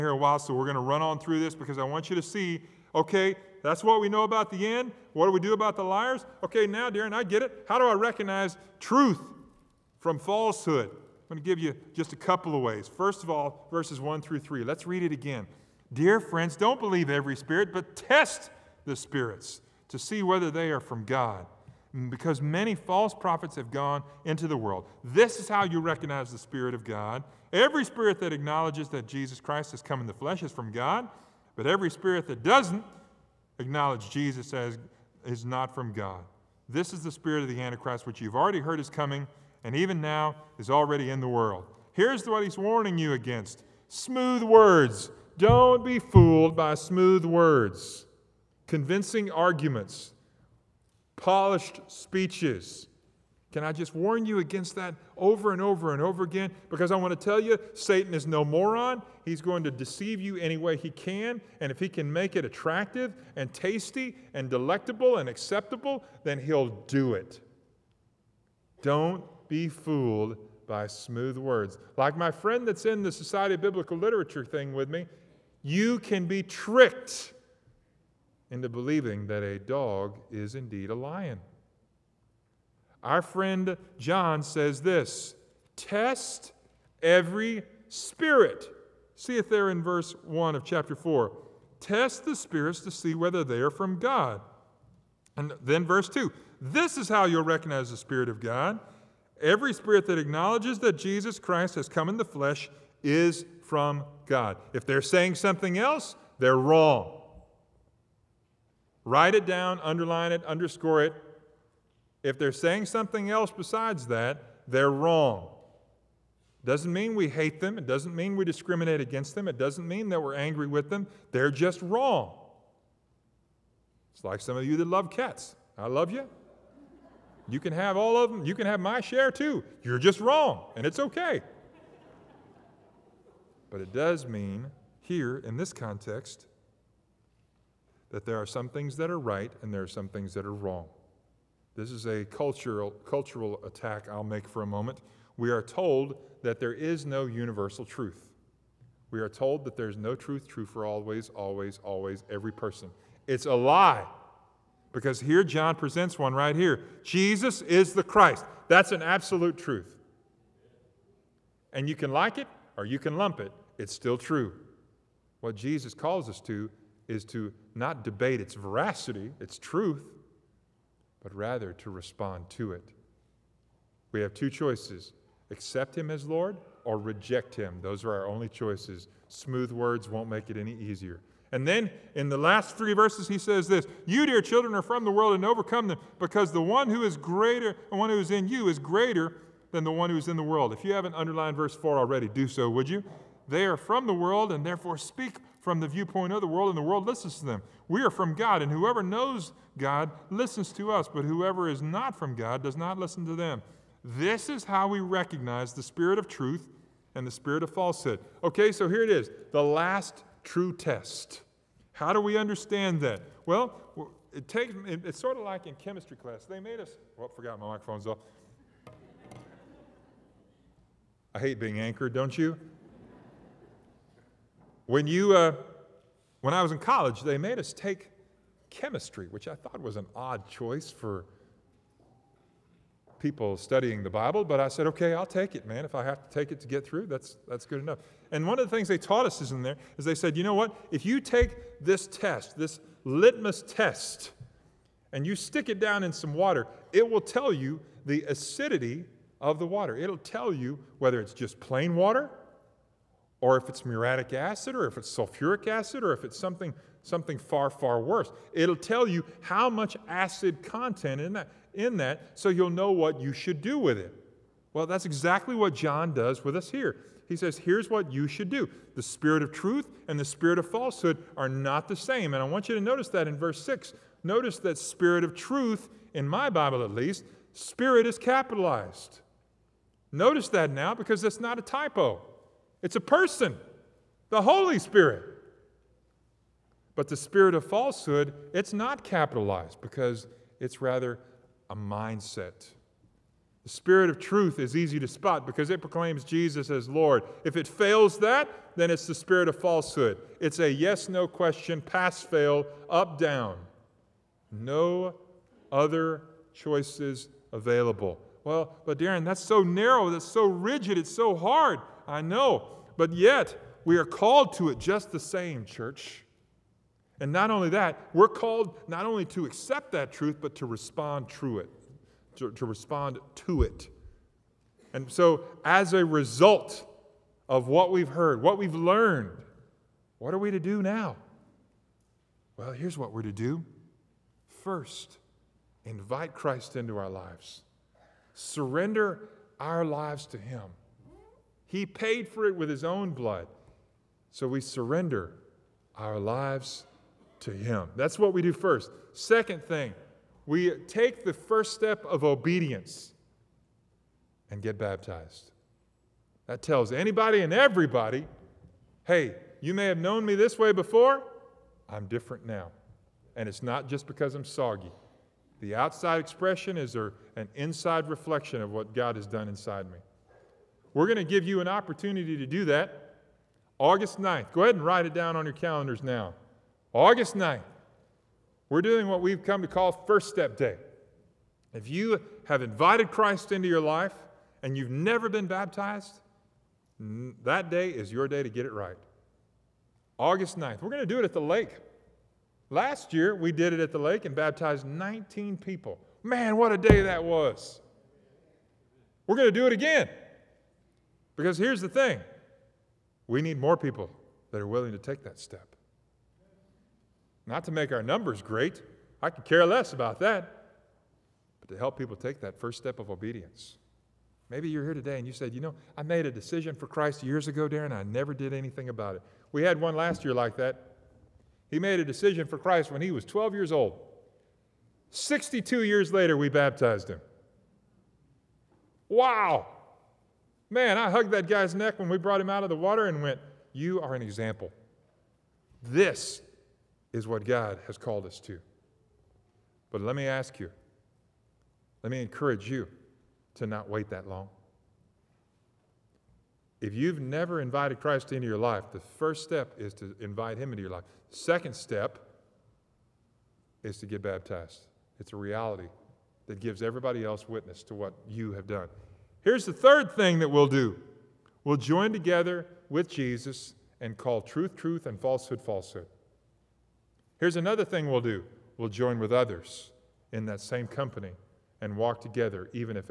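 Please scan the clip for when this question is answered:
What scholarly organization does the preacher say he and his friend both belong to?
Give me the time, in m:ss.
1:13.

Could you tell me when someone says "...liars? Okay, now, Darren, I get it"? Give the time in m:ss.
0:05.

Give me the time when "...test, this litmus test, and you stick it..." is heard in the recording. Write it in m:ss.
4:02.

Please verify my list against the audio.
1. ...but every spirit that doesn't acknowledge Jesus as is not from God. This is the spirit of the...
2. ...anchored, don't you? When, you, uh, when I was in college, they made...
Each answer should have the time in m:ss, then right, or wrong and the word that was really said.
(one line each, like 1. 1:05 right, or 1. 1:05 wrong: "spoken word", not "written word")
1. 0:31 right
2. 3:41 right.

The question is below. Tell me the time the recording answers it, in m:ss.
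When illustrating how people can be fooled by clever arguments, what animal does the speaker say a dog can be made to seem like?
1:20.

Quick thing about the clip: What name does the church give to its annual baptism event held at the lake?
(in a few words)
First Step Day.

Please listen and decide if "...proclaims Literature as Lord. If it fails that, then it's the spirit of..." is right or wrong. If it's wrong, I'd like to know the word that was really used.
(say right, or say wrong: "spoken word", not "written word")
wrong: "Jesus", not "Literature".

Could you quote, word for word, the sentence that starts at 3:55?
If I have to take it to get through, that's, that's good enough.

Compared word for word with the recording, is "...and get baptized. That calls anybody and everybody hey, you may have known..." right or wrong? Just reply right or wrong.
wrong.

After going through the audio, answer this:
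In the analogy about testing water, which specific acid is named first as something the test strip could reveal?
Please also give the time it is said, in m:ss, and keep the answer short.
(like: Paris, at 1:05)
muriatic acid, at 4:13.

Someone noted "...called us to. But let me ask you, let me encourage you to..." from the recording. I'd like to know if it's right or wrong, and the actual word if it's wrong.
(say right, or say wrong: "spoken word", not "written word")
right.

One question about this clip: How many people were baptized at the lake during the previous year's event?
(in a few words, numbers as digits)
19.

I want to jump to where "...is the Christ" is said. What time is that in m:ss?
2:37.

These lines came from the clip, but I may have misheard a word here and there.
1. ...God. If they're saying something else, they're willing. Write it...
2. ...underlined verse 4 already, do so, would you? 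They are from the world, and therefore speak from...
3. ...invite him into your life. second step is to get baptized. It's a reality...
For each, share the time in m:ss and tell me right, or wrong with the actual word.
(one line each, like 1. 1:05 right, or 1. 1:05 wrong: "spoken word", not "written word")
1. 1:44 wrong: "wrong", not "willing"
2. 3:11 right
3. 7:30 right.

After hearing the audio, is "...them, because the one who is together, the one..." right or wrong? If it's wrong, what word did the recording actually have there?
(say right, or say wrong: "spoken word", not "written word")
wrong: "greater", not "together".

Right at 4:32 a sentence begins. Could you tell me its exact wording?
And I want you to notice that in verse 6.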